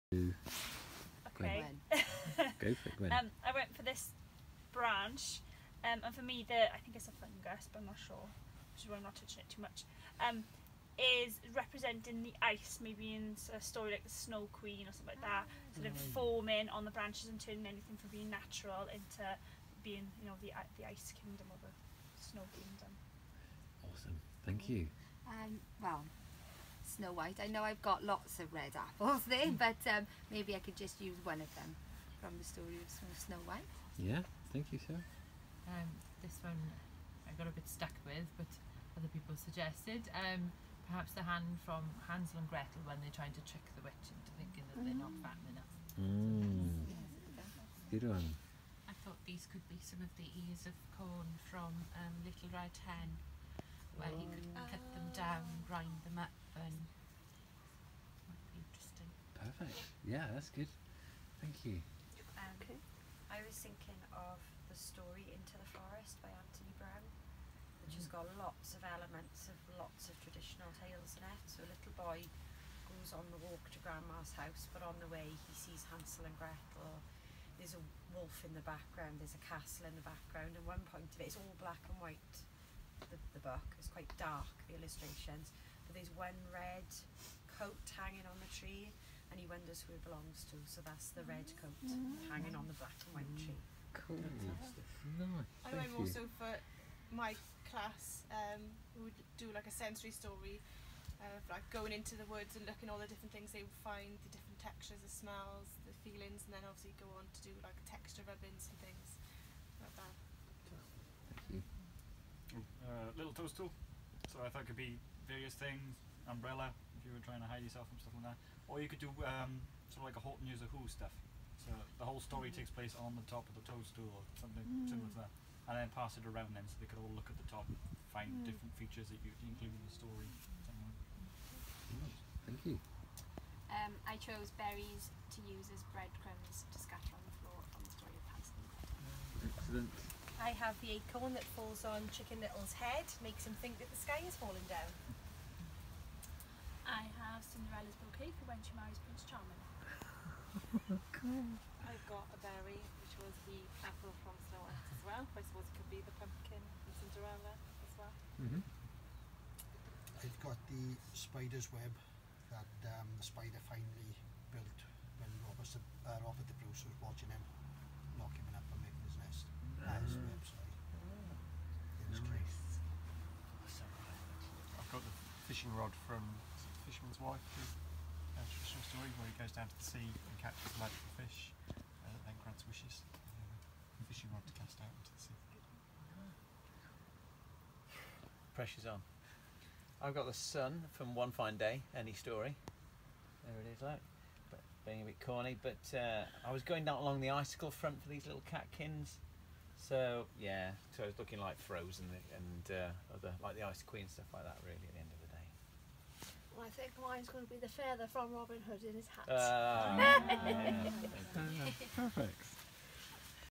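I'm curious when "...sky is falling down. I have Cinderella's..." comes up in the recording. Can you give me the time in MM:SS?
02:24.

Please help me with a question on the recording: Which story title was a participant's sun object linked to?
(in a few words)
One Fine Day.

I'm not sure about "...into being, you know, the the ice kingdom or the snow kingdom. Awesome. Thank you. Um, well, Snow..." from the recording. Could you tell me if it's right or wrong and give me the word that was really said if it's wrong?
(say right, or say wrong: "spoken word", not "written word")
right.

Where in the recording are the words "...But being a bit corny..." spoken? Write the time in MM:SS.
03:14.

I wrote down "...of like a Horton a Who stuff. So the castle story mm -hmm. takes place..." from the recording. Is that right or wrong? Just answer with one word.
wrong.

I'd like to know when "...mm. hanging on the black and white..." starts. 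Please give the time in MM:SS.
01:31.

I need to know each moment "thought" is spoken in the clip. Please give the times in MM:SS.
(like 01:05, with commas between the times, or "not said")
00:49, 01:54.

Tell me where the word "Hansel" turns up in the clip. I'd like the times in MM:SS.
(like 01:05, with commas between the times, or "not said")
00:42, 01:15, 02:18.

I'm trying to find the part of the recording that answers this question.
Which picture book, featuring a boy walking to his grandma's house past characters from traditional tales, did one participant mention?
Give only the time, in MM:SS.
01:05.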